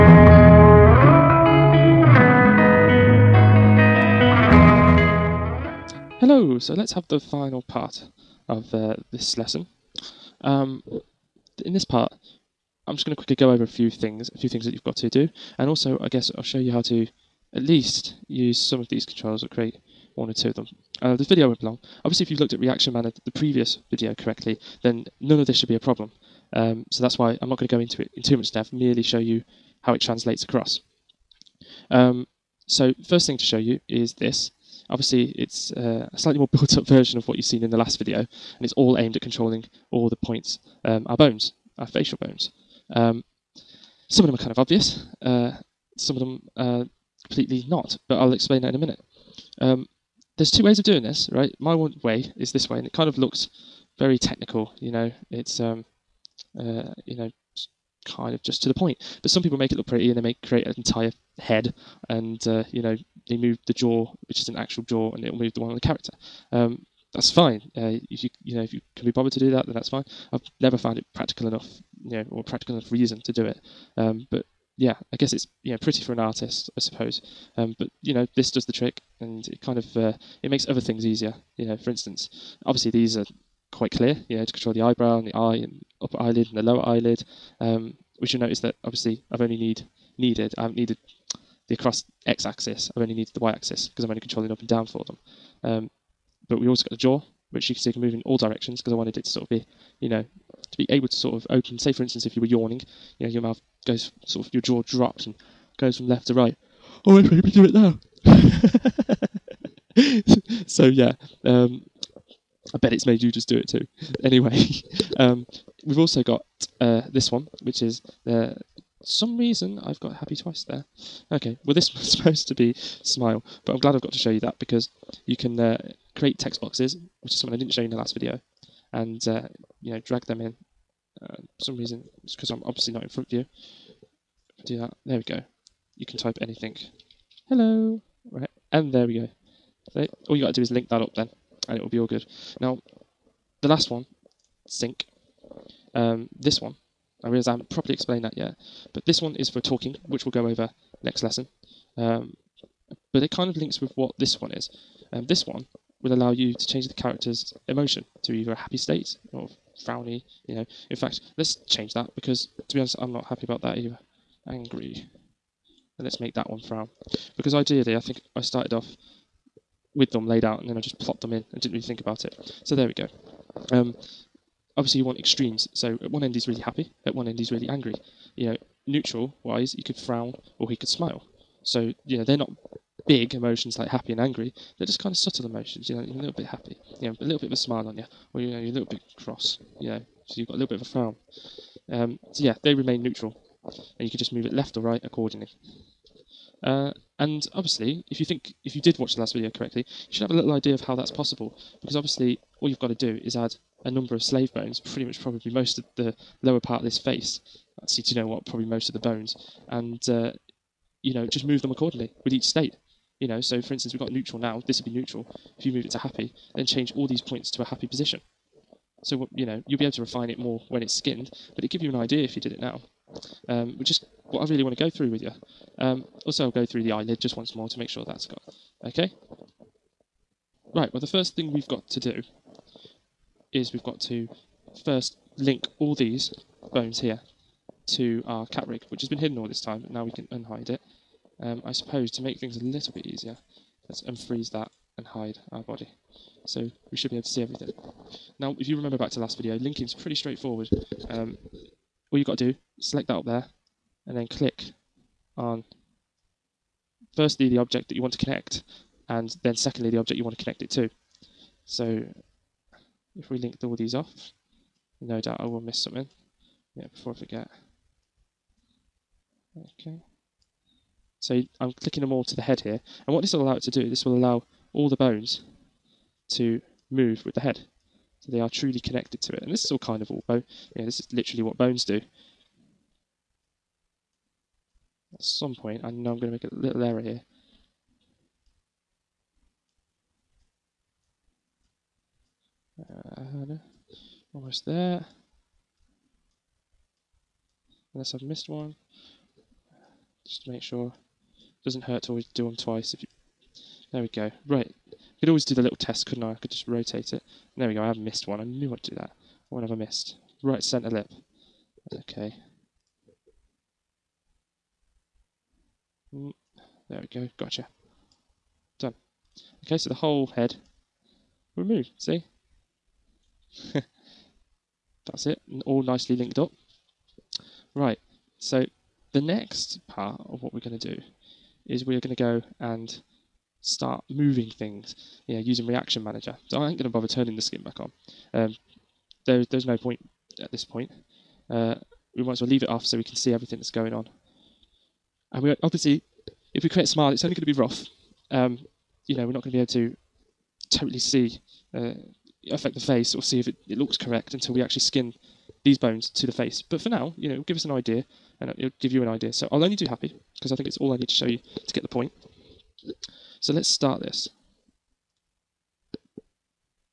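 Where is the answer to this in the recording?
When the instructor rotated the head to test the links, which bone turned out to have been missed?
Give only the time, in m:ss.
5:10.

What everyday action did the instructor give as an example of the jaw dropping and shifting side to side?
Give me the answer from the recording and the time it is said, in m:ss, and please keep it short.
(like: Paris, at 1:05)
yawning, at 1:42.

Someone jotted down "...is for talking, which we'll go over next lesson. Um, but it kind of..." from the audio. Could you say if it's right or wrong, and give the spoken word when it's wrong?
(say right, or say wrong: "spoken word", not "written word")
right.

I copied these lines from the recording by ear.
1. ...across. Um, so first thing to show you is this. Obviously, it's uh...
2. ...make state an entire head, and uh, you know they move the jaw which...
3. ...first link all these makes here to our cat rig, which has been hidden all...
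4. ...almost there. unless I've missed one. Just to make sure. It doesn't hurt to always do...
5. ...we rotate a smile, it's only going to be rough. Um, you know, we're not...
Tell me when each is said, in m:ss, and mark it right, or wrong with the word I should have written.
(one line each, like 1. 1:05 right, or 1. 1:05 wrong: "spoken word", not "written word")
1. 0:30 right
2. 1:00 wrong: "create", not "state"
3. 3:54 wrong: "bones", not "makes"
4. 4:54 right
5. 5:46 wrong: "create", not "rotate".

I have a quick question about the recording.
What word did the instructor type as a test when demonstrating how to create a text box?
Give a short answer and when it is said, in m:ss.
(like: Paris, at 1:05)
Hello, at 2:17.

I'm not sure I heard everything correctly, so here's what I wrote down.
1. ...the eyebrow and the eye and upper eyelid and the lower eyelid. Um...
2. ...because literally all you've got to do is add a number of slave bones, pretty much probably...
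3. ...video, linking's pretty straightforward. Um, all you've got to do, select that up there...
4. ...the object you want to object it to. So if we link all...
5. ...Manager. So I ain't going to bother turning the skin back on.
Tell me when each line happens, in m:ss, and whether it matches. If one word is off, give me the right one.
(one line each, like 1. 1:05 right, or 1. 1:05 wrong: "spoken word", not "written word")
1. 1:24 right
2. 3:21 wrong: "obviously", not "literally"
3. 4:09 right
4. 4:19 wrong: "connect", not "object"
5. 5:36 right.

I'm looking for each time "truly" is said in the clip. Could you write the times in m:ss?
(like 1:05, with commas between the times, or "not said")
4:38.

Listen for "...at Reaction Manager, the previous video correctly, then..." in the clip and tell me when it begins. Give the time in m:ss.
0:22.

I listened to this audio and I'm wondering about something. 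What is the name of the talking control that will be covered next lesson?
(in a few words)
sync.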